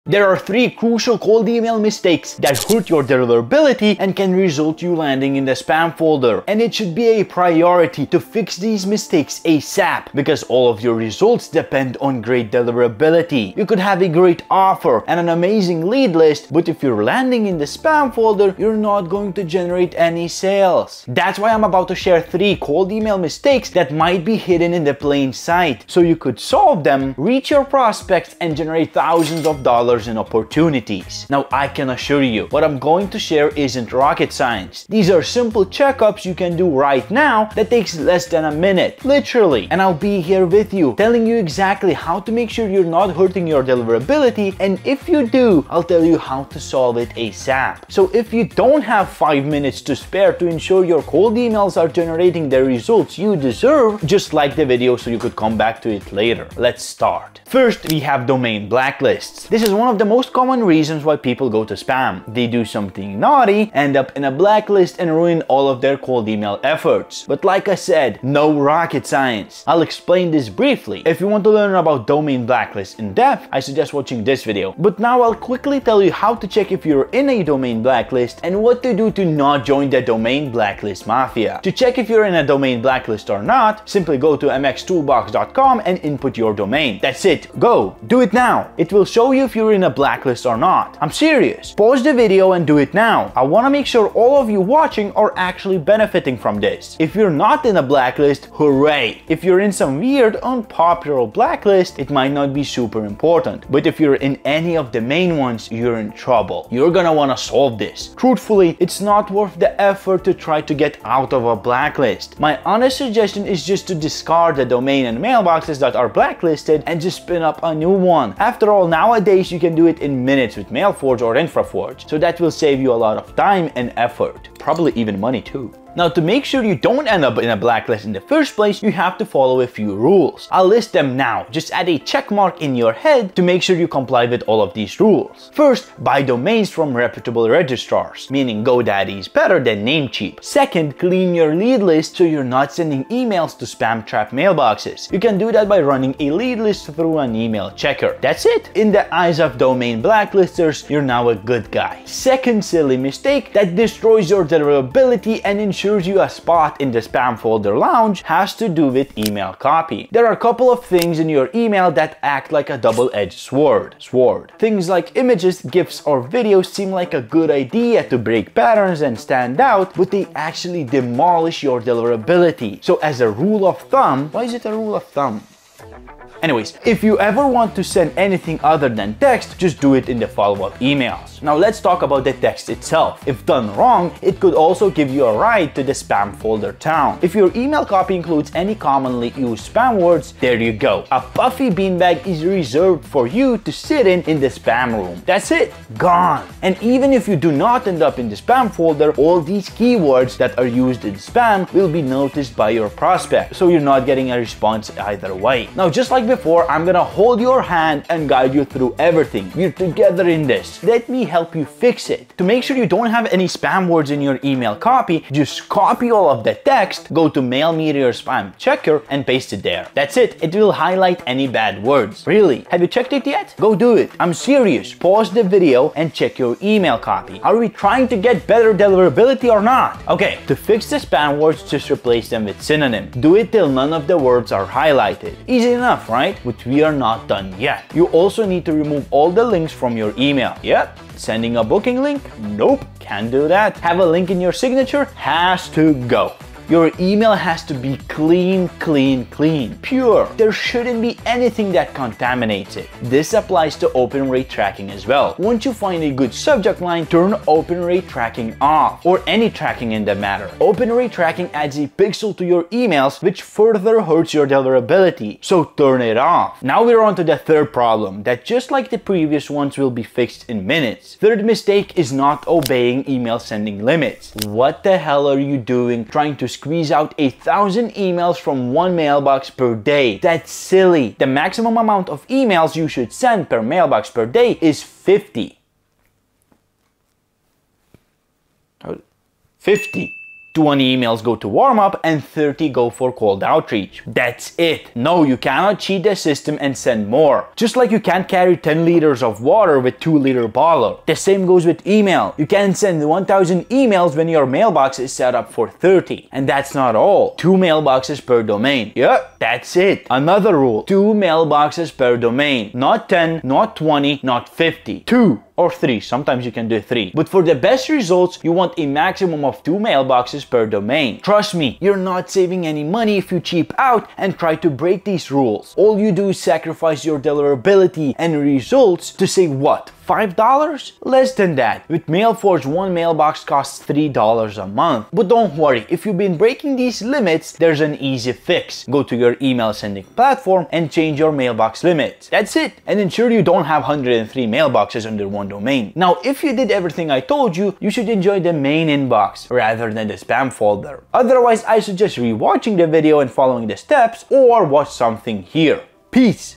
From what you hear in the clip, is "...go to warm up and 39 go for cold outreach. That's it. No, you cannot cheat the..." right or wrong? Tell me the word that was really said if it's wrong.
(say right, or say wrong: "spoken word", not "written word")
wrong: "30", not "39".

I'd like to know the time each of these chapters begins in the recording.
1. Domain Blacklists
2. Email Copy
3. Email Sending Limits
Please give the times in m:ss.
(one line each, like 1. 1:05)
1. 0:57
2. 2:31
3. 4:26.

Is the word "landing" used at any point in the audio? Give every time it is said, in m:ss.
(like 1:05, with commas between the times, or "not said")
0:04, 0:17.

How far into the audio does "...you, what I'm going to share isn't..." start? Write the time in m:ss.
0:32.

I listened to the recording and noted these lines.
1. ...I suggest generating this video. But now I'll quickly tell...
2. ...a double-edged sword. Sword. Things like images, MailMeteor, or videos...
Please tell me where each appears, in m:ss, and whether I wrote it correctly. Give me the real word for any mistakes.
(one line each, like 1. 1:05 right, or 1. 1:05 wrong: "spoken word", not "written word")
1. 1:13 wrong: "watching", not "generating"
2. 2:42 wrong: "GIFs", not "MailMeteor".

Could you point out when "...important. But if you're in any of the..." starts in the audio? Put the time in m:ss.
1:43.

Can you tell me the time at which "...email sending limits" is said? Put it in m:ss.
4:33.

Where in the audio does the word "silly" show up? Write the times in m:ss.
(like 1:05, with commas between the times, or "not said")
2:32, 4:40.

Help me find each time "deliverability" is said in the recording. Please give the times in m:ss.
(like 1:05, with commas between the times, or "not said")
0:03, 0:12, 0:43, 2:34, 2:51, 3:48, 4:24, 5:27.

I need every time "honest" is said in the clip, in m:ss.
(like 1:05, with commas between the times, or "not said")
1:52.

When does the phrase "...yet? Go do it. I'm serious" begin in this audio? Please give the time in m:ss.
3:43.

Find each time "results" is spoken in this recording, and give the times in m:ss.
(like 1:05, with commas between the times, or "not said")
0:04, 0:10, 0:52, 5:17, 5:28.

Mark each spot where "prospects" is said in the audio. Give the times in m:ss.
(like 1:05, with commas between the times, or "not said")
0:27, 3:22.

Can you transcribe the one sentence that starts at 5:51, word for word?
Otherwise, I suggest rewatching the video and following the steps or watch something here.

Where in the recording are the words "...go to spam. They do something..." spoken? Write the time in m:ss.
1:01.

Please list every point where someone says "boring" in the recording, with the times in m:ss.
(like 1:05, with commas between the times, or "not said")
not said.